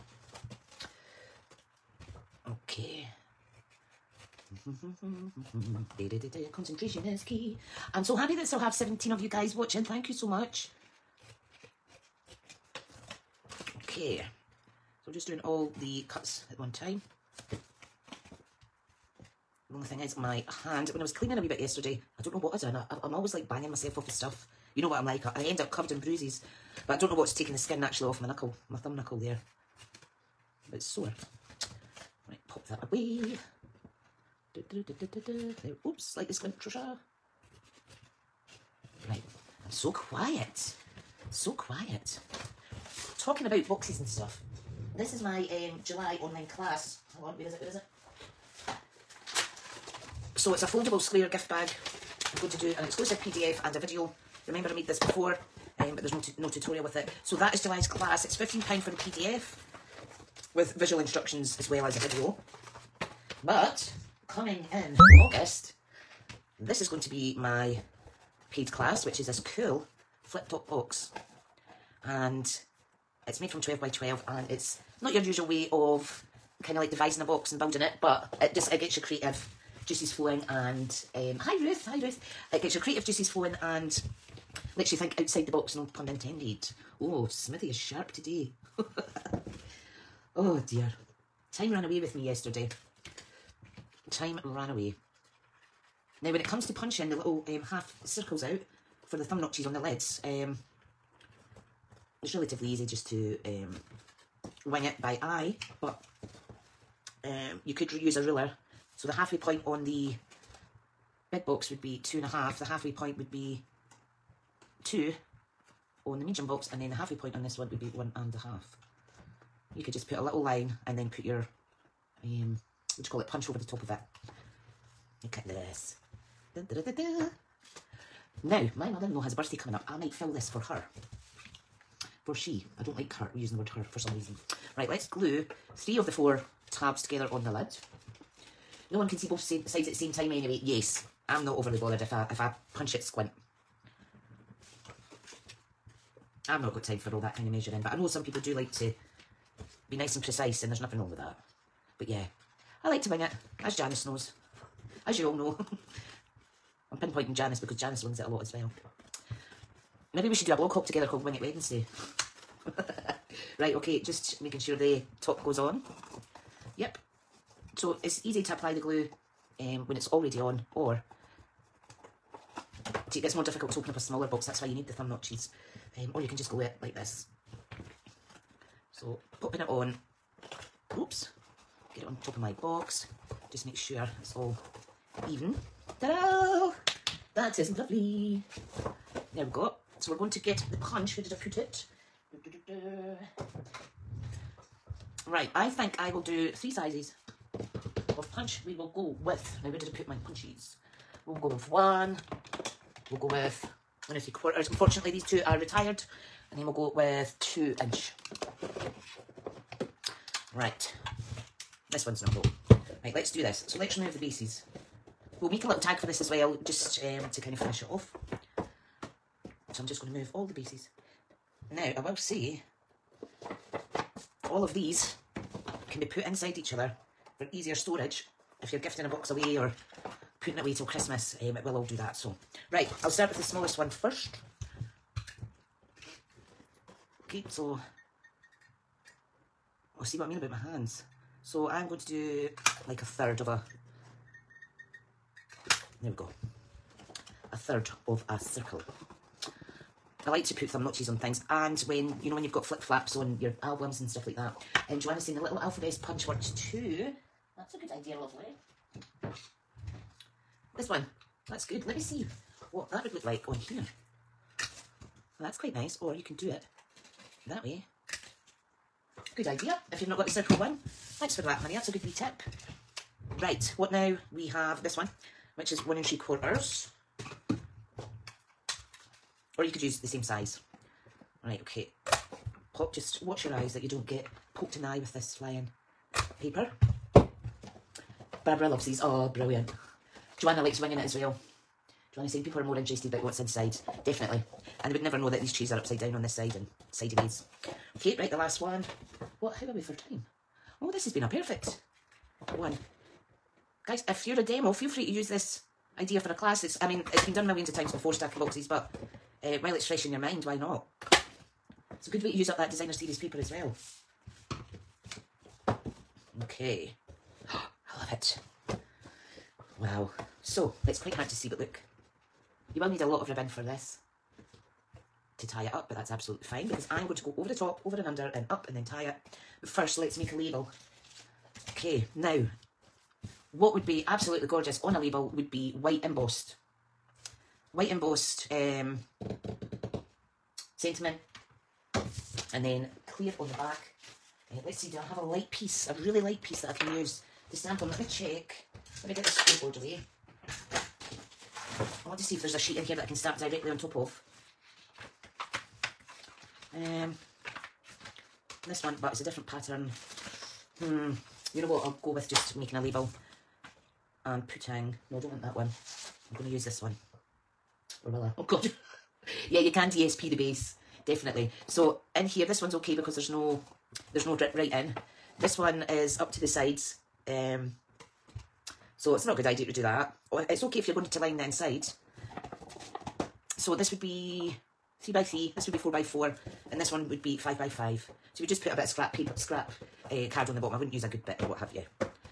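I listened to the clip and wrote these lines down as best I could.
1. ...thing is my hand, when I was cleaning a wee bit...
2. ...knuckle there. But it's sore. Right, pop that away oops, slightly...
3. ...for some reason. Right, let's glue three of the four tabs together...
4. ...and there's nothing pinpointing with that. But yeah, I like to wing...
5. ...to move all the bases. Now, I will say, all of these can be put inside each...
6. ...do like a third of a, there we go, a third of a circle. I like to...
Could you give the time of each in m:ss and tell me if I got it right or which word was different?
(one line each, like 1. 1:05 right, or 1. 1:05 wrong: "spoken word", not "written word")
1. 0:19 right
2. 0:28 right
3. 2:13 right
4. 2:30 wrong: "wrong", not "pinpointing"
5. 3:40 right
6. 4:02 right.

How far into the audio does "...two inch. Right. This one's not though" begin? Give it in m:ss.
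3:27.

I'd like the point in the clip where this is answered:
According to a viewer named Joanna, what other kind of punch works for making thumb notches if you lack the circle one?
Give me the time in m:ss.
4:15.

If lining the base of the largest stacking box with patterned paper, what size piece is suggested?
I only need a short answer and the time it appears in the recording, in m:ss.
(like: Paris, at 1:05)
5 by 5, at 6:27.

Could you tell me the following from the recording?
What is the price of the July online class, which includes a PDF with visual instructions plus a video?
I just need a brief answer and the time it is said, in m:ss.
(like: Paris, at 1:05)
£15, at 0:58.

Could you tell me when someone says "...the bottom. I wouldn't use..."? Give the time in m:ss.
6:30.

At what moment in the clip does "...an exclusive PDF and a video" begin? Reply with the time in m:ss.
0:52.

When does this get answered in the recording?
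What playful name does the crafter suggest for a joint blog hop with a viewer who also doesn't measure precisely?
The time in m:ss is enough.
2:41.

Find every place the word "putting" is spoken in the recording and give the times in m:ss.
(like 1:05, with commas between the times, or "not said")
3:50, 6:04.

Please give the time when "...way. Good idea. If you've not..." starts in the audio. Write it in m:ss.
4:27.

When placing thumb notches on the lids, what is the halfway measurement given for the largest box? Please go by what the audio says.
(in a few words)
2 and a half.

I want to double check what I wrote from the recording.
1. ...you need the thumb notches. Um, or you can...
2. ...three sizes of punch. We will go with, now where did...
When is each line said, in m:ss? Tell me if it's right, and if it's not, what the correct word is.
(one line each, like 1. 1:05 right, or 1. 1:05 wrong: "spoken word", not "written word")
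1. 2:54 right
2. 3:16 right.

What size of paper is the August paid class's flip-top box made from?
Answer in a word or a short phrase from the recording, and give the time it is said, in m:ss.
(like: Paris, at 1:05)
12 by 12, at 1:13.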